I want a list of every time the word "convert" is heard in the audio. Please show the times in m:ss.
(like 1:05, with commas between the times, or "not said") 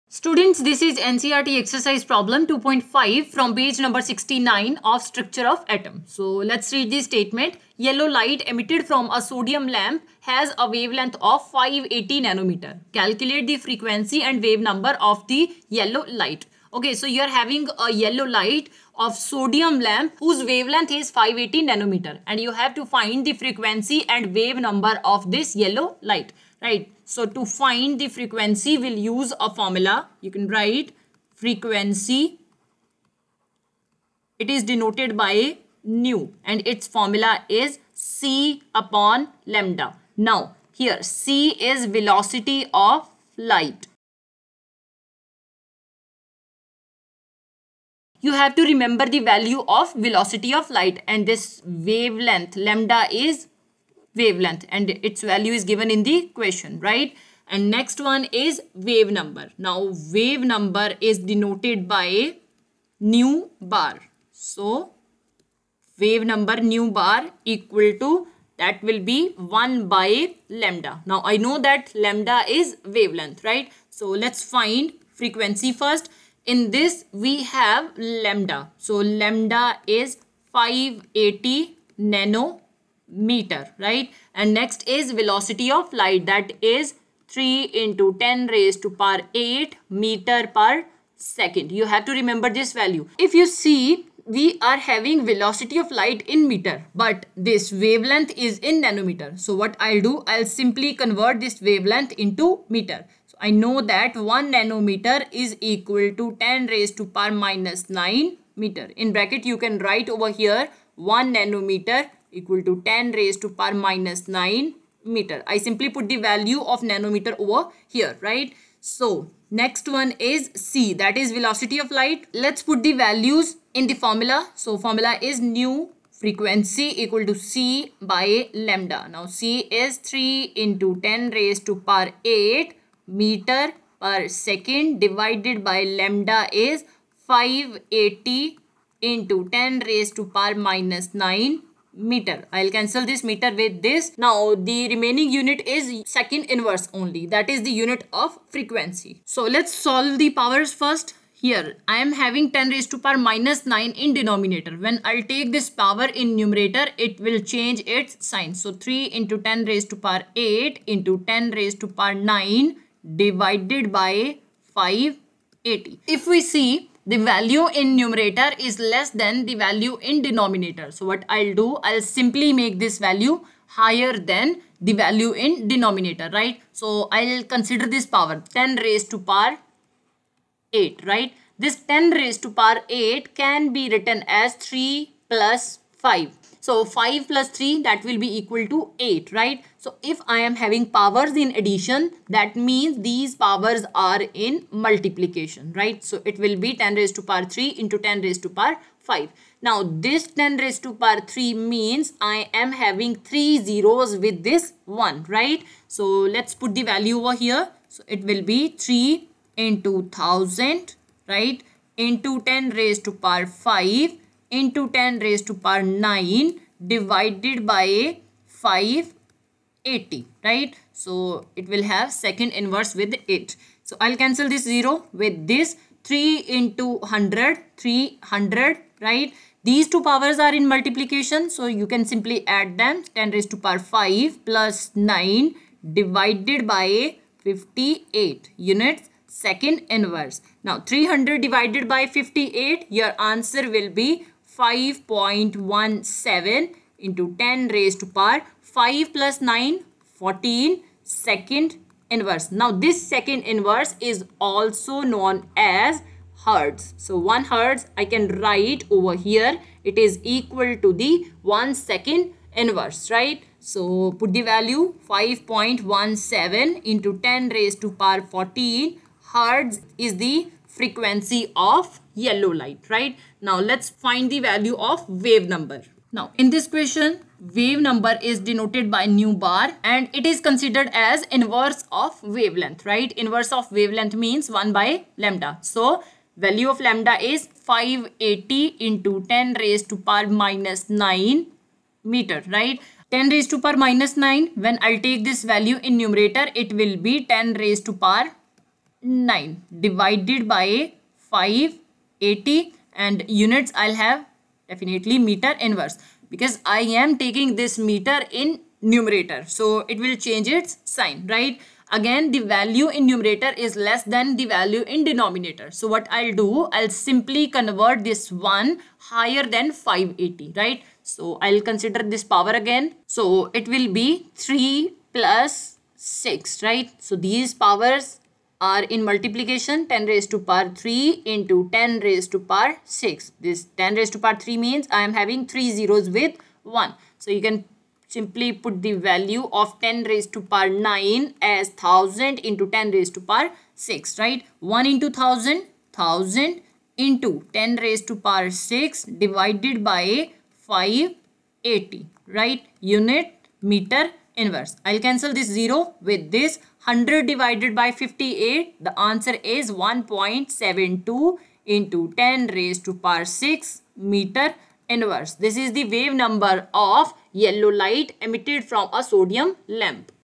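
1:40, 5:17.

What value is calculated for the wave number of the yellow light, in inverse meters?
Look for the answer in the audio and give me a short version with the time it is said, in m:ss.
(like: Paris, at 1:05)
1.72 x 10^6 m^-1, at 5:59.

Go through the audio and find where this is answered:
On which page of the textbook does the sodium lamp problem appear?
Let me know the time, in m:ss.
0:04.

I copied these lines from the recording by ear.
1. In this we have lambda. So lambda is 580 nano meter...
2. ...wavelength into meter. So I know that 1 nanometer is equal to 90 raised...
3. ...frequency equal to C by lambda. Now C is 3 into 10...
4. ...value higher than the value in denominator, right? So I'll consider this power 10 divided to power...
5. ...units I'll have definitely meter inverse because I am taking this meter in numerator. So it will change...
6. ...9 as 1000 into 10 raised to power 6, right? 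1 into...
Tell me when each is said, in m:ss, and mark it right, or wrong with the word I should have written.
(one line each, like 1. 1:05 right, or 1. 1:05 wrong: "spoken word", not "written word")
1. 1:16 right
2. 1:41 wrong: "10", not "90"
3. 2:06 right
4. 2:52 wrong: "raised", not "divided"
5. 5:03 right
6. 5:40 right.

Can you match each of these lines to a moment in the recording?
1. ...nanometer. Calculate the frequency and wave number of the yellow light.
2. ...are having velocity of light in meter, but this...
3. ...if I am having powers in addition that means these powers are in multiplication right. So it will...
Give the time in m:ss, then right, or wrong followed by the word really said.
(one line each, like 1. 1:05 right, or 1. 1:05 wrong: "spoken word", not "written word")
1. 0:12 right
2. 1:34 right
3. 3:10 right.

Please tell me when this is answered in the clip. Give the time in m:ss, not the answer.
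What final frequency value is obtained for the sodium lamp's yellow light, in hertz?
4:25.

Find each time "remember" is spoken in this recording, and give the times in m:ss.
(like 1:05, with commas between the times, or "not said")
0:48, 1:32.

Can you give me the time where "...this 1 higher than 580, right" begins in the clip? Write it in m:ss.
5:18.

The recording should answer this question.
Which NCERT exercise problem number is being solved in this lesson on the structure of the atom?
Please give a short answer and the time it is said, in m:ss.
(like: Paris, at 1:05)
2.5, at 0:02.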